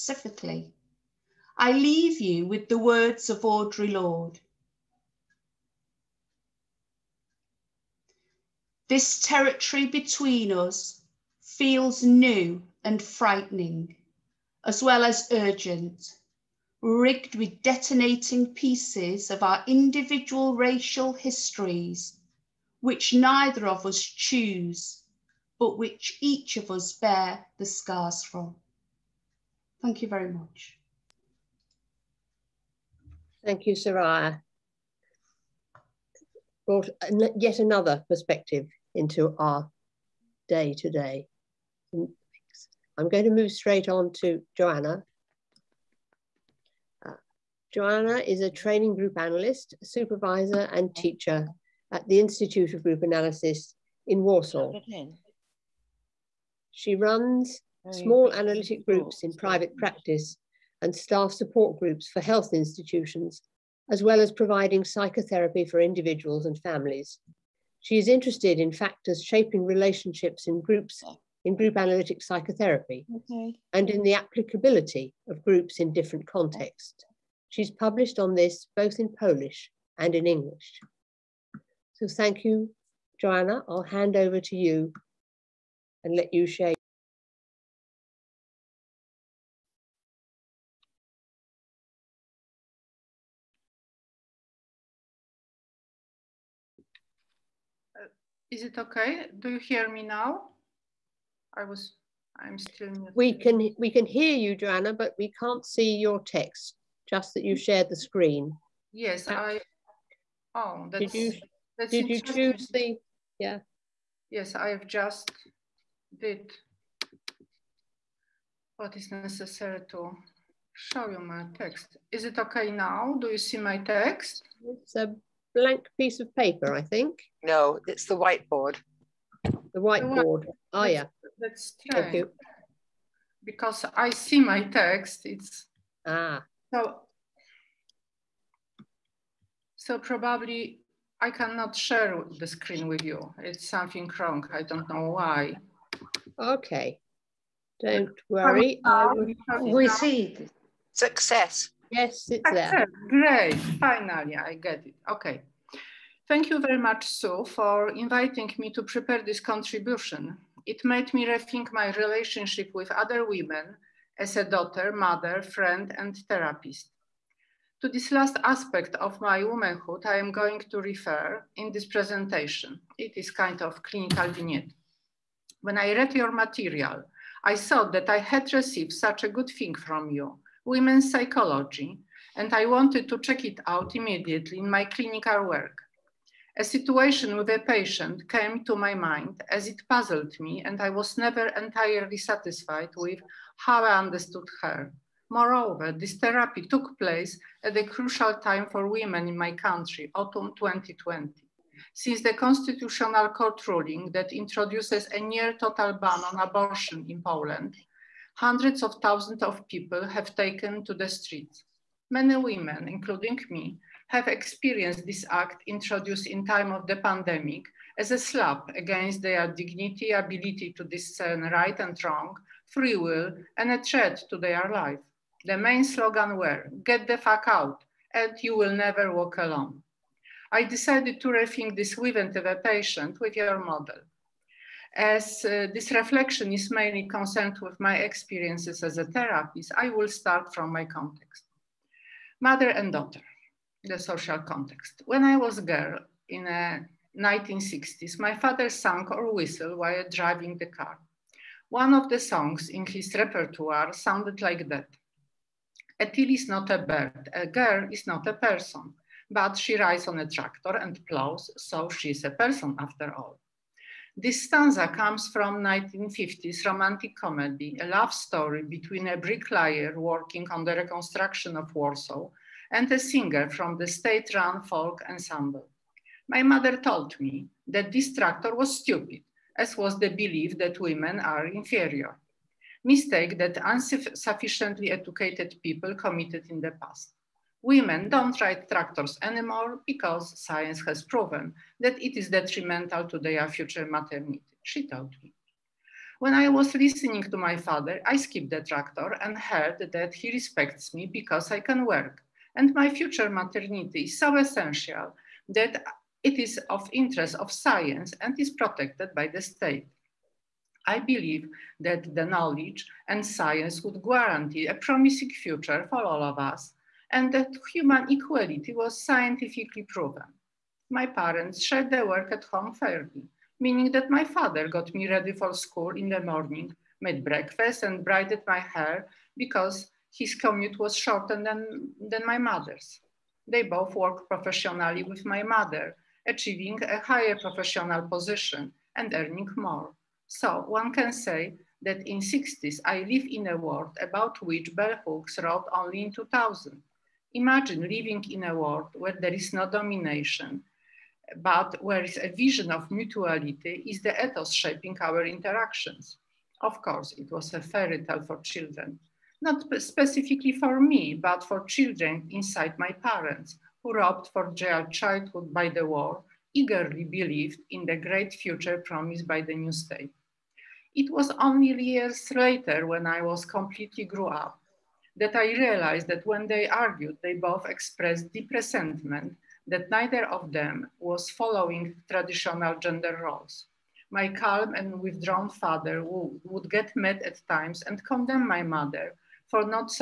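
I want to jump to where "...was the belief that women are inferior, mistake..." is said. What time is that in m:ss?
4:39.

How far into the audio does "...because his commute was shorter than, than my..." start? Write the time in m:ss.
5:29.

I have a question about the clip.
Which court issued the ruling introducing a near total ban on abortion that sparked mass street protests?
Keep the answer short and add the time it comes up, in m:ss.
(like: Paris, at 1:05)
Constitutional Court, at 3:22.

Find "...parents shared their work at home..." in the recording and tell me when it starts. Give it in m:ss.
5:21.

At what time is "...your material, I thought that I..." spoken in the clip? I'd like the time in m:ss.
2:56.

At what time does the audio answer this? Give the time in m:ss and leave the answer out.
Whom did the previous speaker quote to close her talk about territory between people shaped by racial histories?
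0:03.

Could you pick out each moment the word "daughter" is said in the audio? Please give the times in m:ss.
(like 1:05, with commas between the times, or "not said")
2:44, 4:02.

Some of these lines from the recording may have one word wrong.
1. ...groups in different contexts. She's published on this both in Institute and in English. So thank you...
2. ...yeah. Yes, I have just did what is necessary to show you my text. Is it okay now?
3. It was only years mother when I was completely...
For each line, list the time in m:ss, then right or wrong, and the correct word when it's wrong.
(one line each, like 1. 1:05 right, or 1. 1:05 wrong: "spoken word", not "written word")
1. 1:15 wrong: "Polish", not "Institute"
2. 1:53 right
3. 6:10 wrong: "later", not "mother".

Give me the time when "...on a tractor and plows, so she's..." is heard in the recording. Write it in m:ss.
4:20.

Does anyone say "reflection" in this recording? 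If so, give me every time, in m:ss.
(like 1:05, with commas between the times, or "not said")
3:55.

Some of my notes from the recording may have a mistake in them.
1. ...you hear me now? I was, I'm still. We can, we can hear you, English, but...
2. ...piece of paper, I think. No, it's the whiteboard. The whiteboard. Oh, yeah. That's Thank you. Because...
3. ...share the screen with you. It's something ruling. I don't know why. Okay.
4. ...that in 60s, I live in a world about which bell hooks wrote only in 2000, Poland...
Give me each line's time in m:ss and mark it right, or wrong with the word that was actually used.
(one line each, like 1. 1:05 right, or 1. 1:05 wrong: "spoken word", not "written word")
1. 1:39 wrong: "Joanna", not "English"
2. 2:05 right
3. 2:21 wrong: "wrong", not "ruling"
4. 5:41 wrong: "Imagine", not "Poland".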